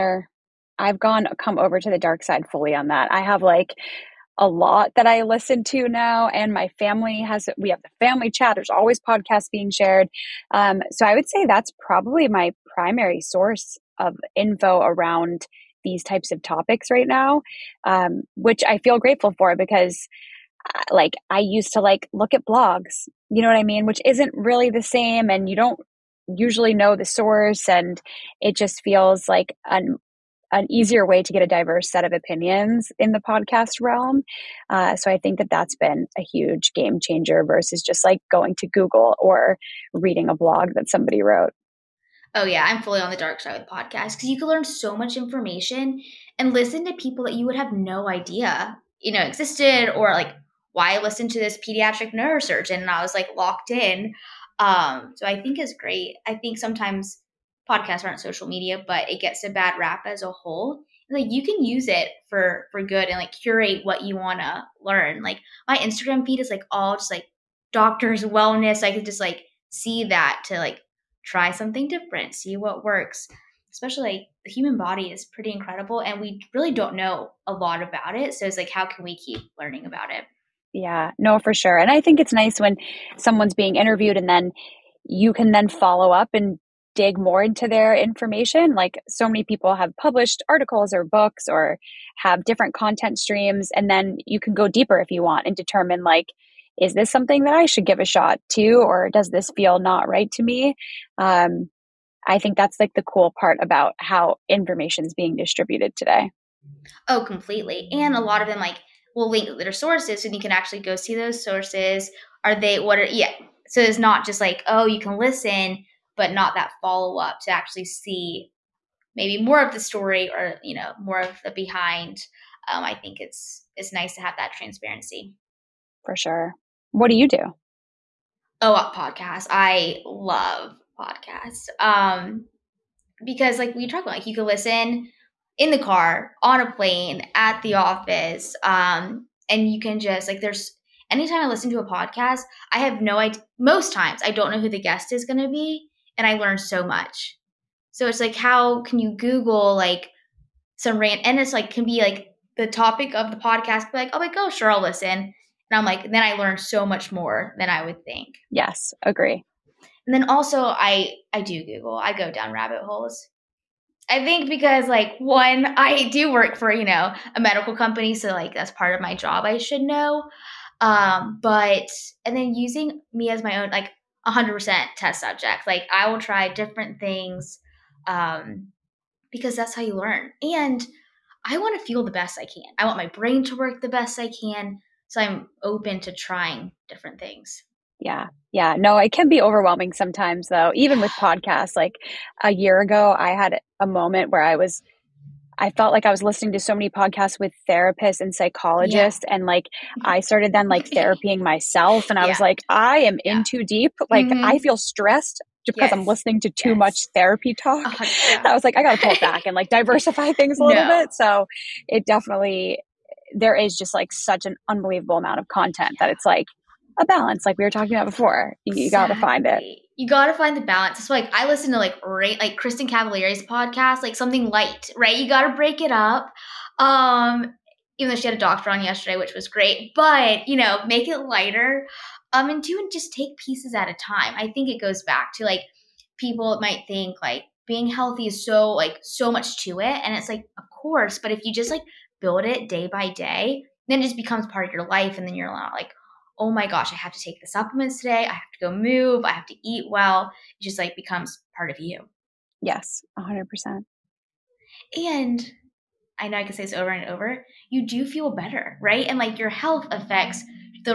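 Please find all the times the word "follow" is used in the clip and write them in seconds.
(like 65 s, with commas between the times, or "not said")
85 s, 116 s.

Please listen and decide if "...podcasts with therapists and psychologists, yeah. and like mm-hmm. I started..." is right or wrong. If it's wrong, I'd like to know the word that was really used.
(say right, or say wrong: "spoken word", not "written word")
right.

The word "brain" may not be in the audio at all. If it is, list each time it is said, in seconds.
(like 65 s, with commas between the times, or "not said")
183 s.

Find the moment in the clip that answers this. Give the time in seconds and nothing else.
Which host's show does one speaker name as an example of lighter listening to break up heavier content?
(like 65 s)
222 s.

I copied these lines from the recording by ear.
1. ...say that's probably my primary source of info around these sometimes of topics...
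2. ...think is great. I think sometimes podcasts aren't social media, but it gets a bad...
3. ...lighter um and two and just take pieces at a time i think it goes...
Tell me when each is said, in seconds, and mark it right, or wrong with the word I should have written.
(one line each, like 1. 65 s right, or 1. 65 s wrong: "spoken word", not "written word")
1. 11 s wrong: "types", not "sometimes"
2. 55 s right
3. 231 s right.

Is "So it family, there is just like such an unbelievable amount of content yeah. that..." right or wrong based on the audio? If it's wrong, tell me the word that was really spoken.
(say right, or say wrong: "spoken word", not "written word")
wrong: "definitely", not "family".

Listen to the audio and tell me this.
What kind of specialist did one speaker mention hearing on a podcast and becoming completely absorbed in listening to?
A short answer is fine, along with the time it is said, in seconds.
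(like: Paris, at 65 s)
pediatric neurosurgeon, at 51 s.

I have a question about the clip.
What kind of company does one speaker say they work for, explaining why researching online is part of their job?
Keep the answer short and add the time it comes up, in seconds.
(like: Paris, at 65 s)
a medical company, at 167 s.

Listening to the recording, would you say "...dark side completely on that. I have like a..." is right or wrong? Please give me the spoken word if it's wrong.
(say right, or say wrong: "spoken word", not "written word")
wrong: "fully", not "completely".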